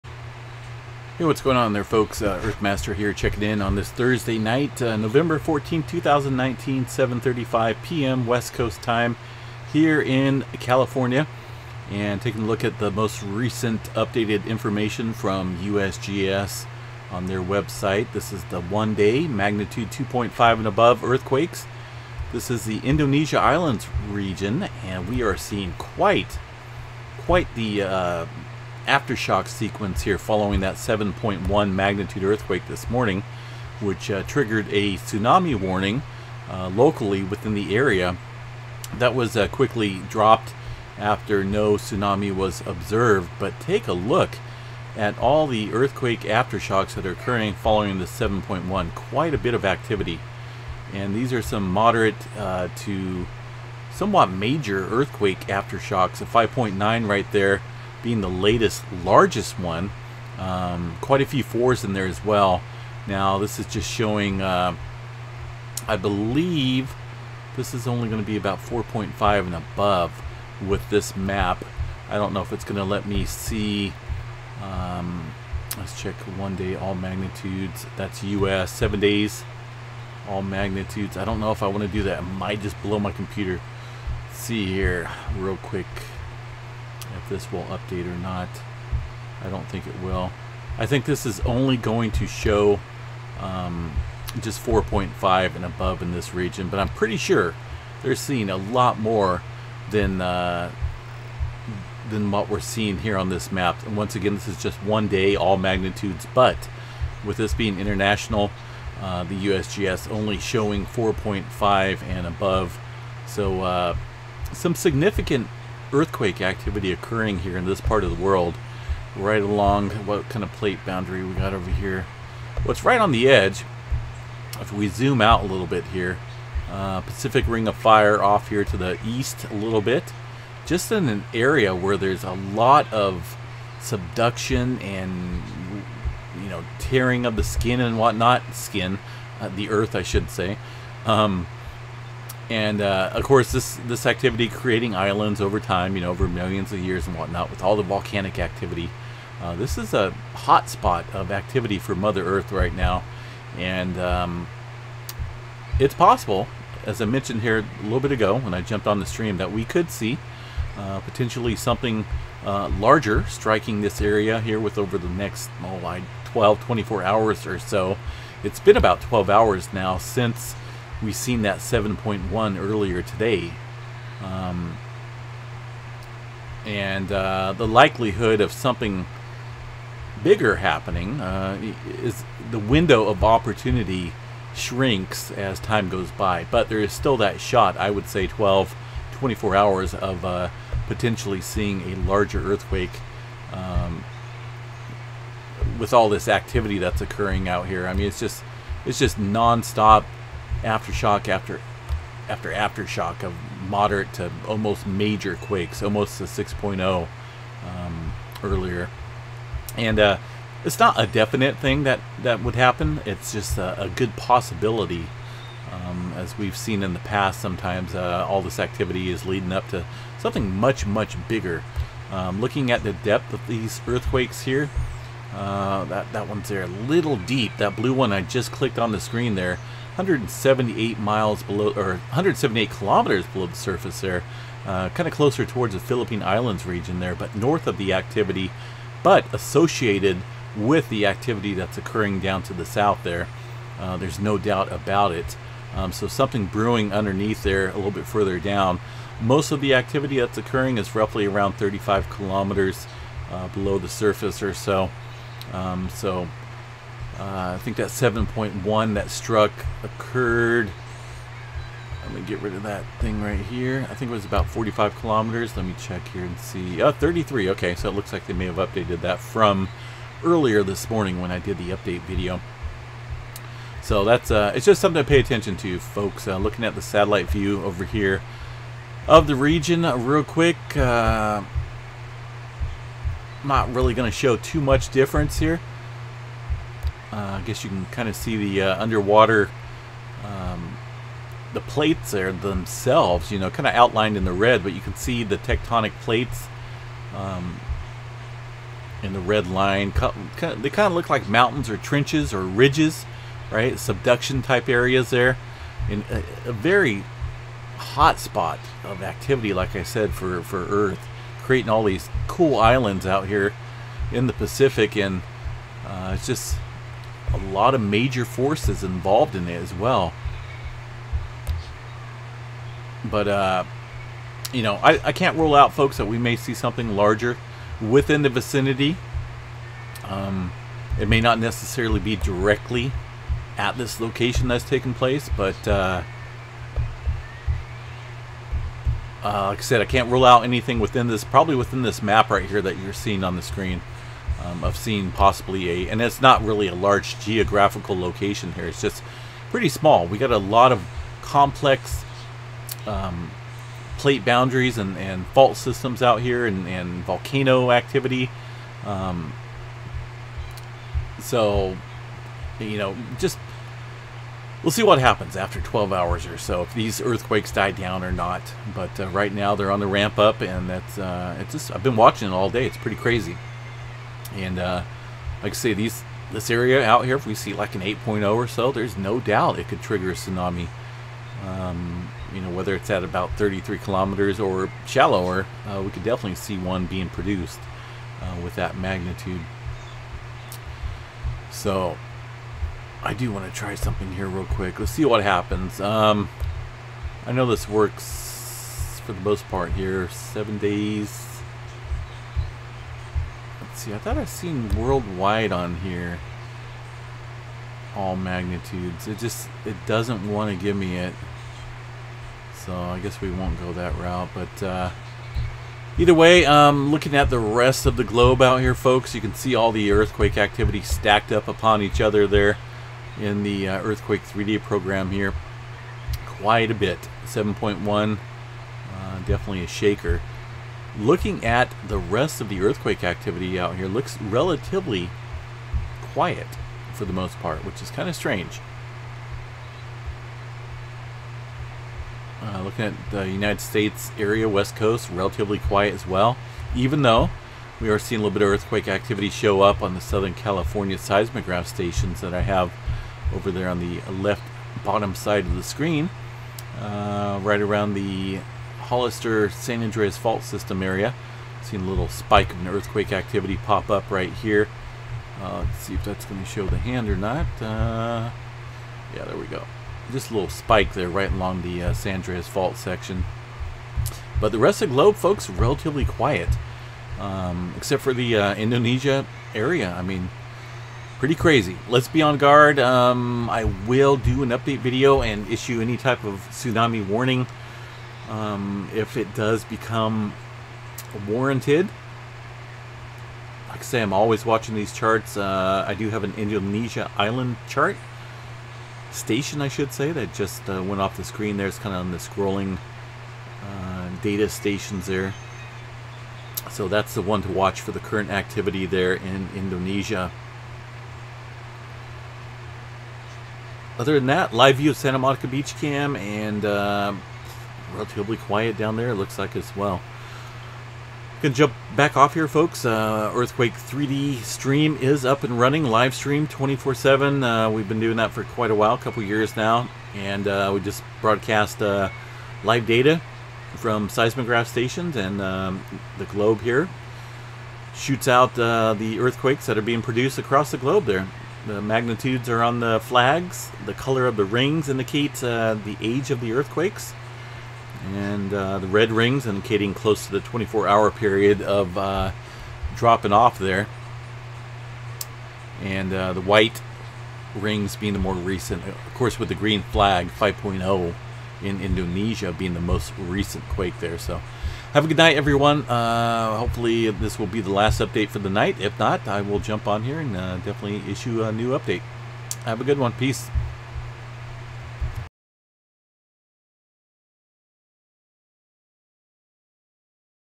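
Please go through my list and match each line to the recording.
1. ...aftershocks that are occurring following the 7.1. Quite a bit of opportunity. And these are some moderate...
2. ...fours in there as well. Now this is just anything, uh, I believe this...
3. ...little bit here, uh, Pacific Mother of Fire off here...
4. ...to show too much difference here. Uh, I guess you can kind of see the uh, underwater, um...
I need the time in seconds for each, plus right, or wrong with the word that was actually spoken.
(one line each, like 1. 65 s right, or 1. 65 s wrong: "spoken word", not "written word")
1. 46 s wrong: "activity", not "opportunity"
2. 61 s wrong: "showing", not "anything"
3. 125 s wrong: "Ring", not "Mother"
4. 284 s right.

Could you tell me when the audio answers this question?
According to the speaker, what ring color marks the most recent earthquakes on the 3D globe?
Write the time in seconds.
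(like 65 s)
556 s.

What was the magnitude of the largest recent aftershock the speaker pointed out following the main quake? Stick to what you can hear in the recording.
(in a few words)
5.9.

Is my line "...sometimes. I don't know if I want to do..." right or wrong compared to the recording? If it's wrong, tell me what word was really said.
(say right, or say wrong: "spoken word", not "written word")
wrong: "magnitudes", not "sometimes".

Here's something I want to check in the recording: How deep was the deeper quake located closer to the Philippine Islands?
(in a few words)
178 kilometers.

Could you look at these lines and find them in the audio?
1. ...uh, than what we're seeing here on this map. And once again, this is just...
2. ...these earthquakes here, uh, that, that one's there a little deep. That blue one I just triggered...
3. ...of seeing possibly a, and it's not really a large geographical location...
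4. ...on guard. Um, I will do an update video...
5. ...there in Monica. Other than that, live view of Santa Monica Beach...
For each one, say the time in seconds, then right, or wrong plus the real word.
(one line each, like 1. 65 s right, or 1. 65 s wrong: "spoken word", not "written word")
1. 100 s right
2. 223 s wrong: "clicked", not "triggered"
3. 344 s right
4. 482 s right
5. 508 s wrong: "Indonesia", not "Monica".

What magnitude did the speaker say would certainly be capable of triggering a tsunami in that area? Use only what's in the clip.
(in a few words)
8.0.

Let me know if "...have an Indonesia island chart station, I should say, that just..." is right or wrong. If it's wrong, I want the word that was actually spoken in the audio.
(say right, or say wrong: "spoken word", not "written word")
right.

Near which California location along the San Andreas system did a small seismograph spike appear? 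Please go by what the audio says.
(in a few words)
Hollister.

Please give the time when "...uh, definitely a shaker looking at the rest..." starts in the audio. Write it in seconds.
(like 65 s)
428 s.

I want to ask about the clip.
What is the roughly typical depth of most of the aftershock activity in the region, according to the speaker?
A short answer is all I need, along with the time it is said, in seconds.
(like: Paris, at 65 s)
35 kilometers, at 251 s.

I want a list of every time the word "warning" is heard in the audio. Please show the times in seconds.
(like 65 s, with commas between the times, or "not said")
35 s, 487 s.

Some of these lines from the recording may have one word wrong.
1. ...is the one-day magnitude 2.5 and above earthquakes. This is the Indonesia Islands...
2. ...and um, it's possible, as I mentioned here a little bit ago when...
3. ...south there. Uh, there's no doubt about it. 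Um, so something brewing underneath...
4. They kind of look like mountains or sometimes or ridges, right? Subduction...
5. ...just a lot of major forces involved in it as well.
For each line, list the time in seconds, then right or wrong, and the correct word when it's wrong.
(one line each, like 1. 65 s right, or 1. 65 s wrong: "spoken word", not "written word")
1. 18 s right
2. 153 s right
3. 242 s right
4. 300 s wrong: "trenches", not "sometimes"
5. 316 s right.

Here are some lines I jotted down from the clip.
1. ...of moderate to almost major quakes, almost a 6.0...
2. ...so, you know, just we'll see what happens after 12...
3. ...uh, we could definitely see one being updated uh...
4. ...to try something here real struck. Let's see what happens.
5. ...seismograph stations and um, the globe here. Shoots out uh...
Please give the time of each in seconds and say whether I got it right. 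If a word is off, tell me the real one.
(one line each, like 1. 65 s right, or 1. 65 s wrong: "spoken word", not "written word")
1. 203 s right
2. 361 s right
3. 385 s wrong: "produced", not "updated"
4. 393 s wrong: "quick", not "struck"
5. 534 s right.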